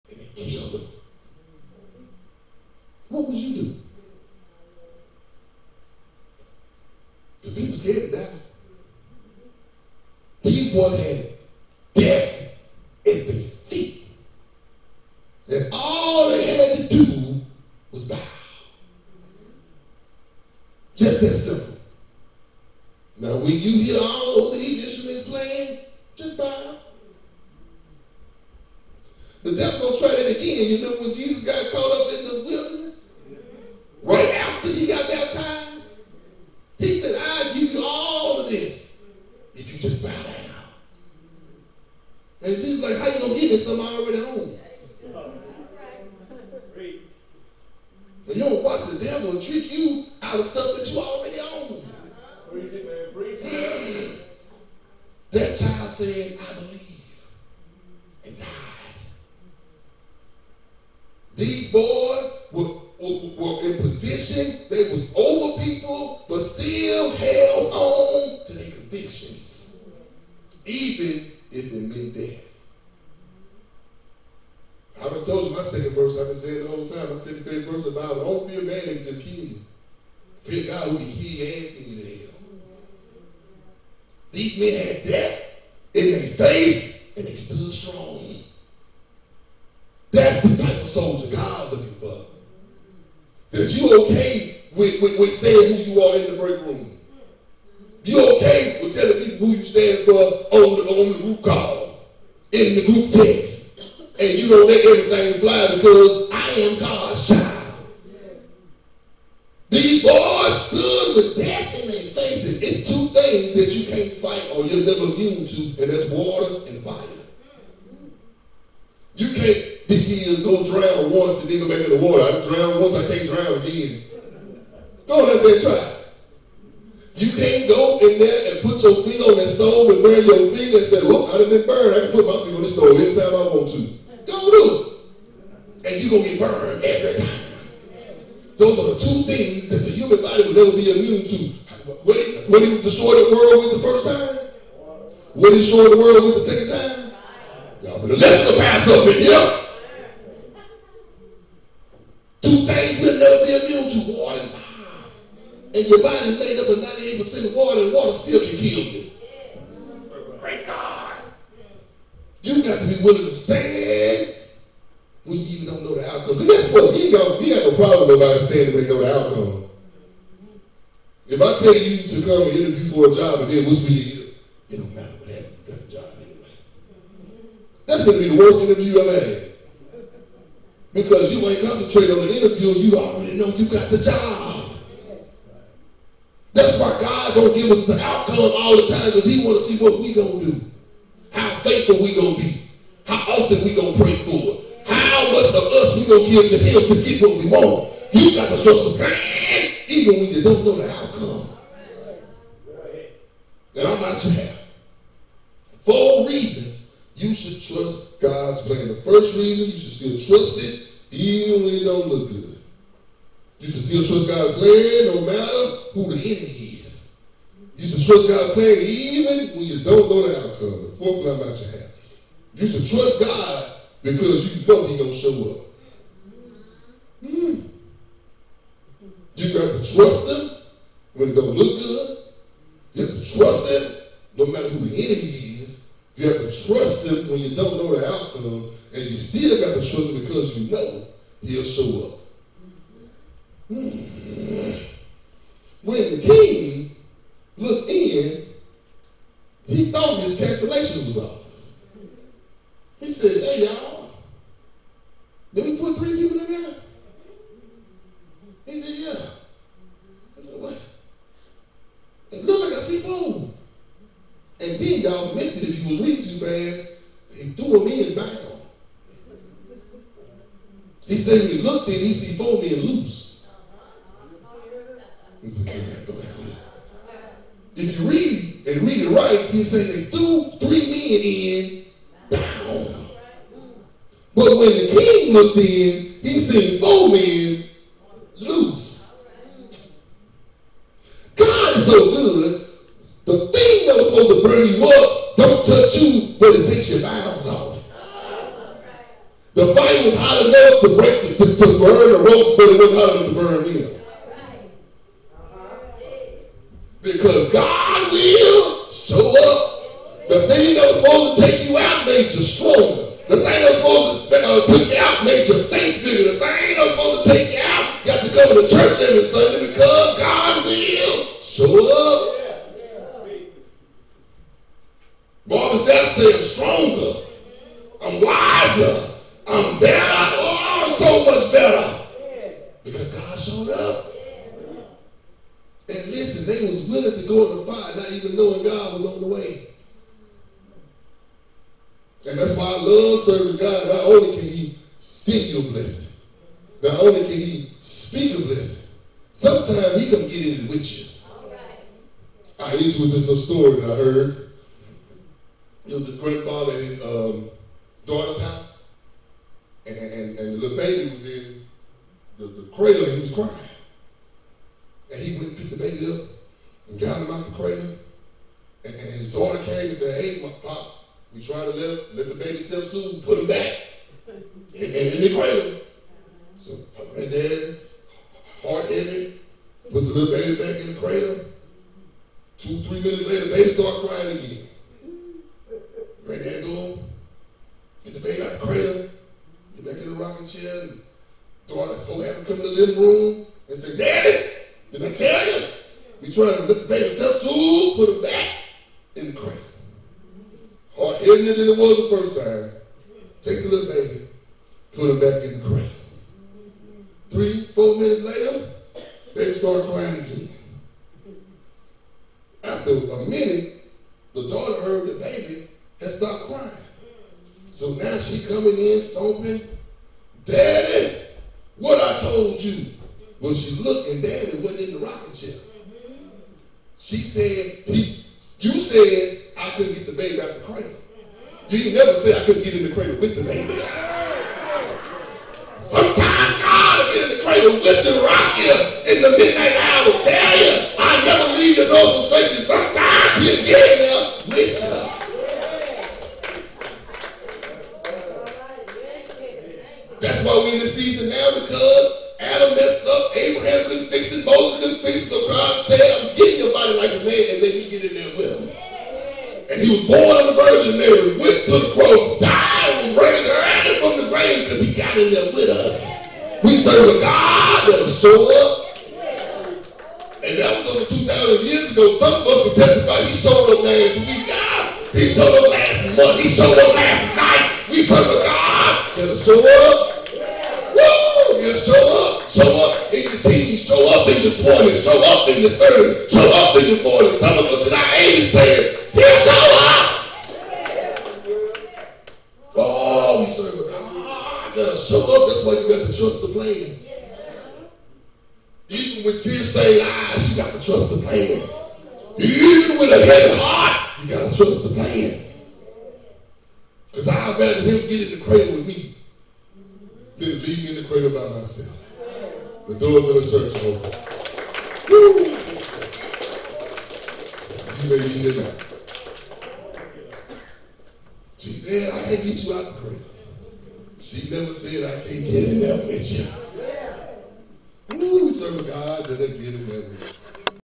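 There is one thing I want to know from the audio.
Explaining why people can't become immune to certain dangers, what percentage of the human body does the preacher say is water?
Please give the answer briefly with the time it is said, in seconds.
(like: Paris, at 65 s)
98%, at 156 s.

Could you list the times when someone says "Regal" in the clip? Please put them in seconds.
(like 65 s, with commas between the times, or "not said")
not said.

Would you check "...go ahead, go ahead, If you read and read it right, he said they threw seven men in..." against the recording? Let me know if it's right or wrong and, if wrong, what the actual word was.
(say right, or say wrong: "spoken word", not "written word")
wrong: "three", not "seven".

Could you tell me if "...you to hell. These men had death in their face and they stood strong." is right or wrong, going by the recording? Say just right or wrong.
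right.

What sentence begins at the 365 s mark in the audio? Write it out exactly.
And he went and picked the baby up and got him out the cradle.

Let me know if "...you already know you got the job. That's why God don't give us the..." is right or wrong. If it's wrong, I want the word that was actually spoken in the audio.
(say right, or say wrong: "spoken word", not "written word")
right.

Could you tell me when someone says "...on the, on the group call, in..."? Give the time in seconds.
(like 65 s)
100 s.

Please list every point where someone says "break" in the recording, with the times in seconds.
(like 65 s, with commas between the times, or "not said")
96 s, 300 s.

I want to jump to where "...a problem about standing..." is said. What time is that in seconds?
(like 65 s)
167 s.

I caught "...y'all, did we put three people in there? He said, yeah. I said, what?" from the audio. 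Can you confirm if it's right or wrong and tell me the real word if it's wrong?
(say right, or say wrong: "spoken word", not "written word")
right.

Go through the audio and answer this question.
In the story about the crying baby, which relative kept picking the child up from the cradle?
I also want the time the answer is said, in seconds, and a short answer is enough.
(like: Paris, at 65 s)
Grandfather, at 356 s.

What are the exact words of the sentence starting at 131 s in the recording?
I can put my feet on the stove anytime I want to.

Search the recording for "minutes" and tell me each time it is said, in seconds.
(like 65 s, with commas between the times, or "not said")
383 s, 407 s, 413 s.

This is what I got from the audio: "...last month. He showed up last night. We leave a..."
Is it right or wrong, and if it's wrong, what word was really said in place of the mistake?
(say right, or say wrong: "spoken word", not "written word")
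wrong: "serve", not "leave".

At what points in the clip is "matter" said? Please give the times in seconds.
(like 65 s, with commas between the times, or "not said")
174 s, 215 s, 234 s.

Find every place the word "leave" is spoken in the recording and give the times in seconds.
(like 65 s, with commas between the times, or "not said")
441 s, 510 s.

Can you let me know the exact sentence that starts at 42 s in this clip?
And Jesus like, how you going to get this?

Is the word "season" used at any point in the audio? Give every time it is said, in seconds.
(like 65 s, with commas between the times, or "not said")
450 s.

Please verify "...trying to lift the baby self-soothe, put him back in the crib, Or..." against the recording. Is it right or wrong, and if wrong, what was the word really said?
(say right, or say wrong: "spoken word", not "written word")
right.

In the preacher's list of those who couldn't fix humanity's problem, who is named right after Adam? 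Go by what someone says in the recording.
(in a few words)
Abraham.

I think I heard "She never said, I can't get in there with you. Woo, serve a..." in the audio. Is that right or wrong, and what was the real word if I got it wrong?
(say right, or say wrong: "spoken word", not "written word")
right.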